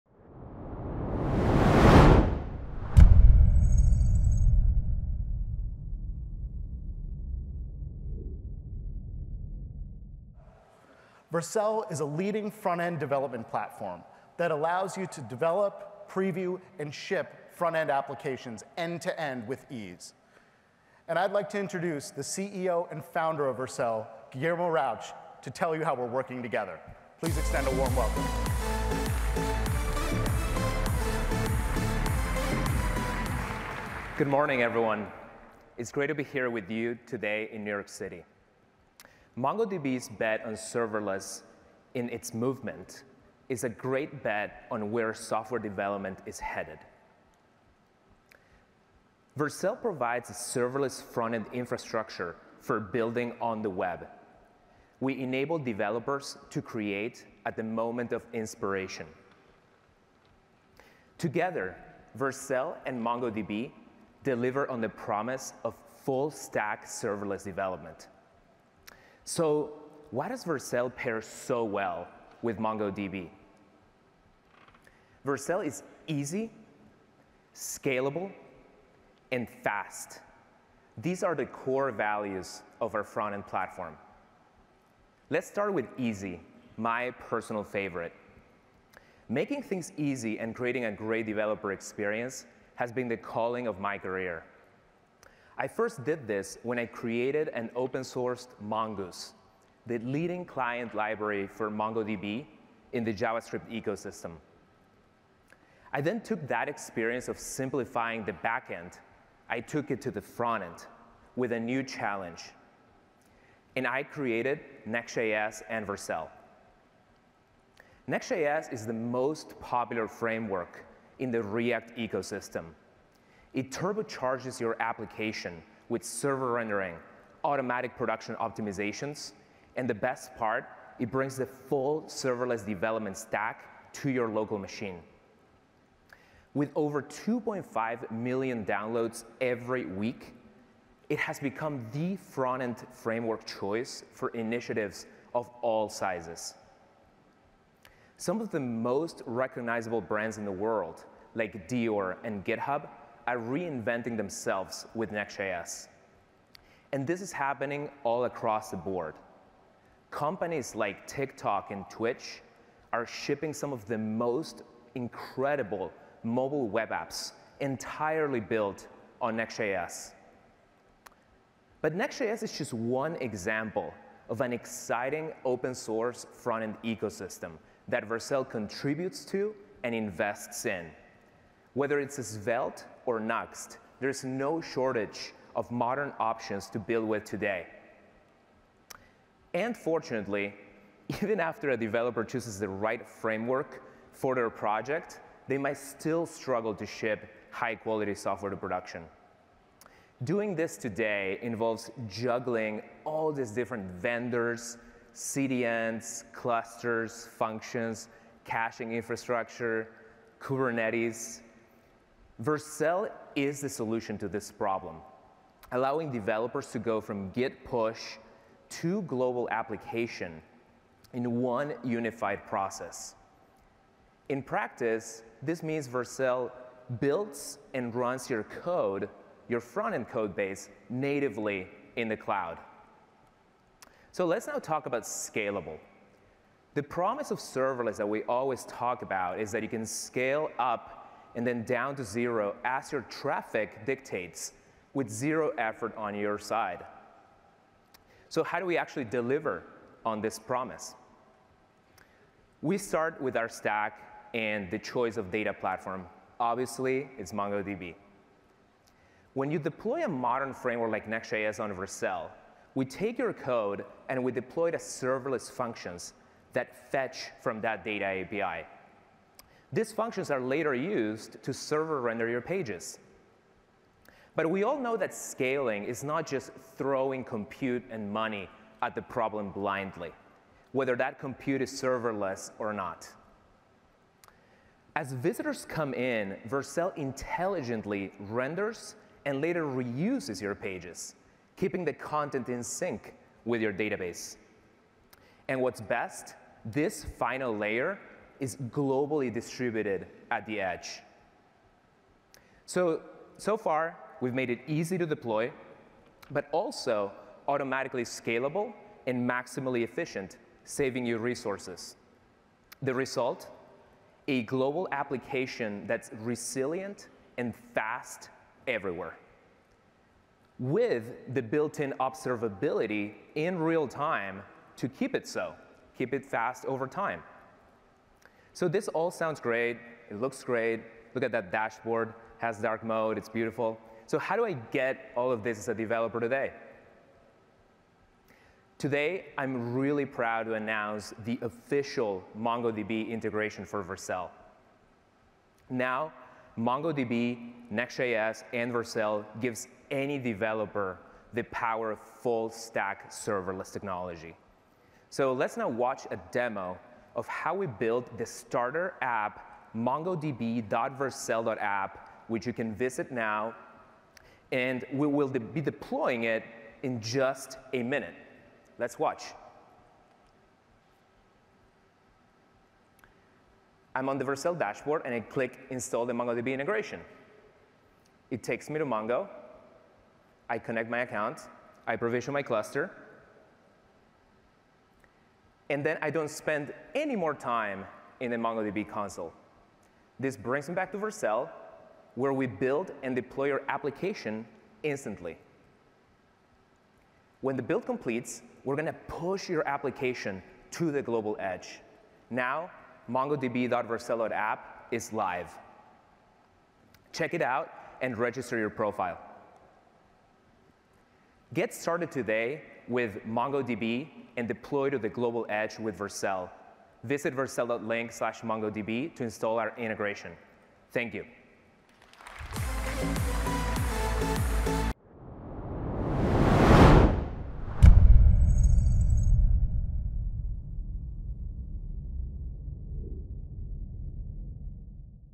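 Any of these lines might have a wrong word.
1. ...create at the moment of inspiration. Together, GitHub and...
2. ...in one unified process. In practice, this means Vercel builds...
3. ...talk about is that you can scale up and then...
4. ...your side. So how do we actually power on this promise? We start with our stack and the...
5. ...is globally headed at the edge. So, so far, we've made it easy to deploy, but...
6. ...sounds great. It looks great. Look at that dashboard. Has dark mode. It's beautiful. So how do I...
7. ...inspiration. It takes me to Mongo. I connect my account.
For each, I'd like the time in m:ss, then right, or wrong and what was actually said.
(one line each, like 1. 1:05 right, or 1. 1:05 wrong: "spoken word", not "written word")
1. 0:56 wrong: "Vercel", not "GitHub"
2. 3:41 right
3. 3:58 right
4. 4:06 wrong: "deliver", not "power"
5. 4:58 wrong: "distributed", not "headed"
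6. 5:29 right
7. 6:16 wrong: "integration", not "inspiration".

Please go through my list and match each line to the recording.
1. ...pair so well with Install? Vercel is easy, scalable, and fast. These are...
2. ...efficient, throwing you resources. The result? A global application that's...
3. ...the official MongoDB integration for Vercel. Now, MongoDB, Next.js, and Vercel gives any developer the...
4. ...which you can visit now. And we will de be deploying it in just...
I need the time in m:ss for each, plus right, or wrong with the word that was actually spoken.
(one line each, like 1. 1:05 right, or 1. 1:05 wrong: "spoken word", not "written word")
1. 1:10 wrong: "MongoDB", not "Install"
2. 5:09 wrong: "saving", not "throwing"
3. 5:41 right
4. 6:02 right.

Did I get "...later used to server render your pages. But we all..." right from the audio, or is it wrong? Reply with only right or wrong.
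right.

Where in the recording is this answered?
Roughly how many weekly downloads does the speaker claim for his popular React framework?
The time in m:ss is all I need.
2:17.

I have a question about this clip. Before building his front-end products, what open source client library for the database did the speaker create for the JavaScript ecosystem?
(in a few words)
Mongoose.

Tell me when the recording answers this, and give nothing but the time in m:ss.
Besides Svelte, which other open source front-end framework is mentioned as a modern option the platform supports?
3:03.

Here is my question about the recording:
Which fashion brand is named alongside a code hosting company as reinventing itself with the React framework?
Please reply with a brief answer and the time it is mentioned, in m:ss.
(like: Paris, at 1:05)
Dior, at 2:31.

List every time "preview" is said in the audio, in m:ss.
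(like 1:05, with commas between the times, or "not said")
0:16.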